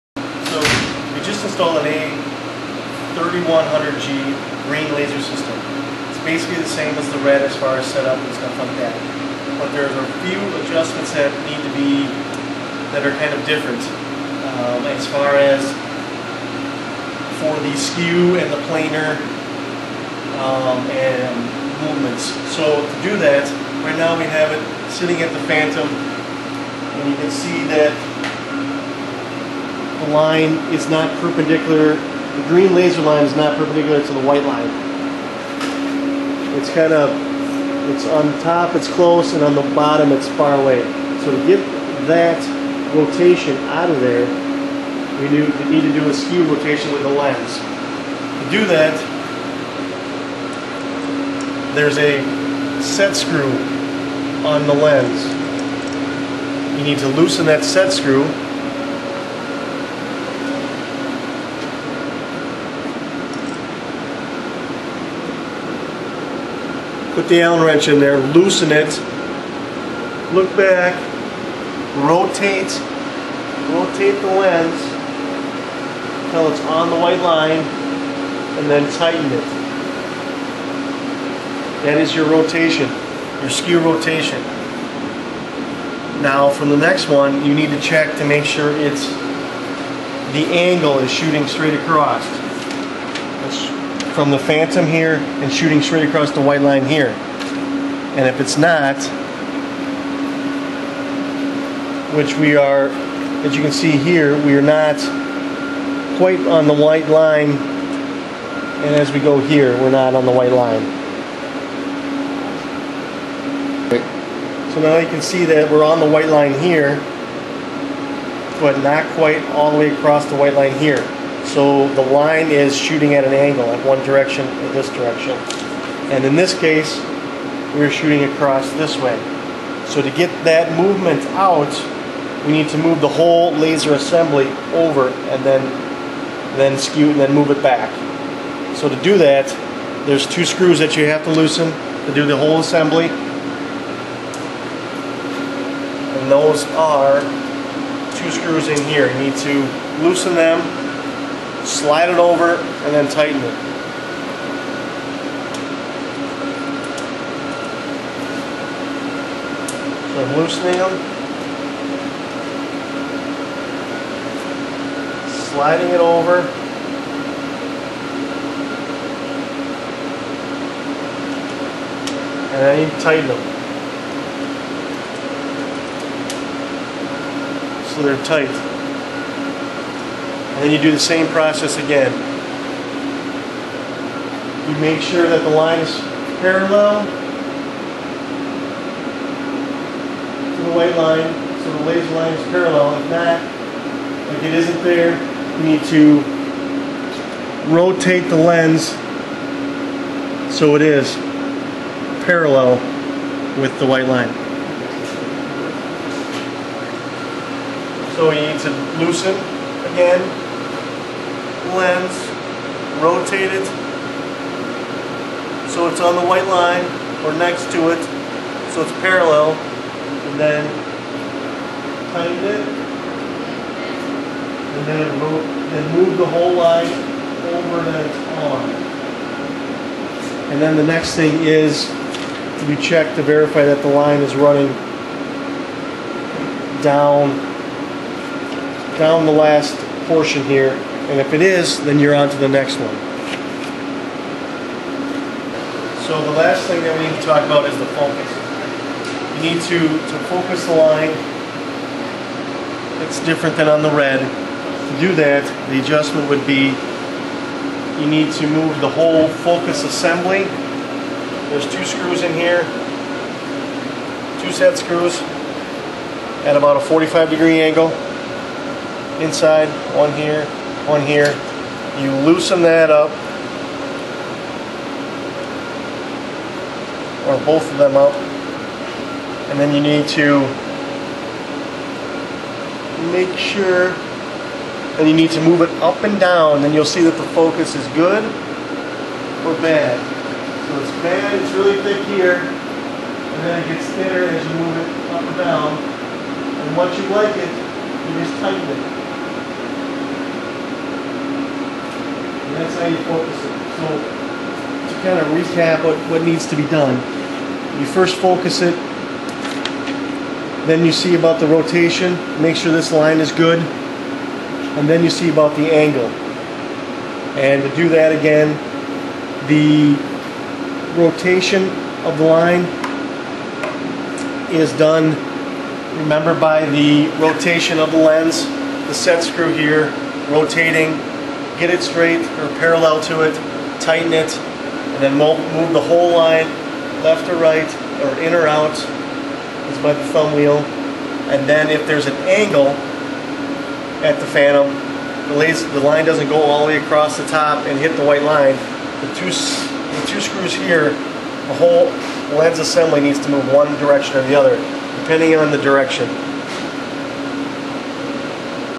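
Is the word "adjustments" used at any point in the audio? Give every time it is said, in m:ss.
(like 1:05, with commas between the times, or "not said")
0:10, 4:15.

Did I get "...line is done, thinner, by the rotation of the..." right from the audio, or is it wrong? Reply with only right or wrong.
wrong.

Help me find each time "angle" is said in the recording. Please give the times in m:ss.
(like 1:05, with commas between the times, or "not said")
1:30, 2:03, 4:27, 5:15, 5:42.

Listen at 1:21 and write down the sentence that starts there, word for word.
That is your rotation, your skew rotation.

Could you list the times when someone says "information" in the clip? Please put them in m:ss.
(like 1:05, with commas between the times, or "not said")
not said.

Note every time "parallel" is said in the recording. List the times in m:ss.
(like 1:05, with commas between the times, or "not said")
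3:06, 3:12, 3:22, 3:38, 5:32.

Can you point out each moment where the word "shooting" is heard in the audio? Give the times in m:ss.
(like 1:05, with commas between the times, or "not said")
1:31, 1:35, 2:02, 2:07.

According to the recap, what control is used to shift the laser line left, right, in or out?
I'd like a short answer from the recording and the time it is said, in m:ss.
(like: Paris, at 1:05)
thumb wheel, at 5:40.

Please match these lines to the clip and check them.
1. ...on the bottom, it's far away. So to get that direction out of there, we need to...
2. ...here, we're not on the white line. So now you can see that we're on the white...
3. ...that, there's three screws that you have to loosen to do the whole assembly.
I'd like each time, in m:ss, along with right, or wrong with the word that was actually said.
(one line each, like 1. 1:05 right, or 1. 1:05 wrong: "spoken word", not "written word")
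1. 0:39 wrong: "rotation", not "direction"
2. 1:49 right
3. 2:19 wrong: "two", not "three".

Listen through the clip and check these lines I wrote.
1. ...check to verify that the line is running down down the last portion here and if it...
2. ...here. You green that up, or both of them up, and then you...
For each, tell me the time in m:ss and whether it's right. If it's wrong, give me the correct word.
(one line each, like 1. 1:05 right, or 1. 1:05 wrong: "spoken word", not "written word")
1. 3:52 right
2. 4:30 wrong: "loosen", not "green".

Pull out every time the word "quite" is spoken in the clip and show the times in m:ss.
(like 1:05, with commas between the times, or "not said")
1:46, 1:59.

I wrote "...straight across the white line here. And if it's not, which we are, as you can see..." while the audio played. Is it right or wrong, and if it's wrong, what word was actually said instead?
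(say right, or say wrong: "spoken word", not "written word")
right.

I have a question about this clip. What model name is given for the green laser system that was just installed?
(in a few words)
A3100G.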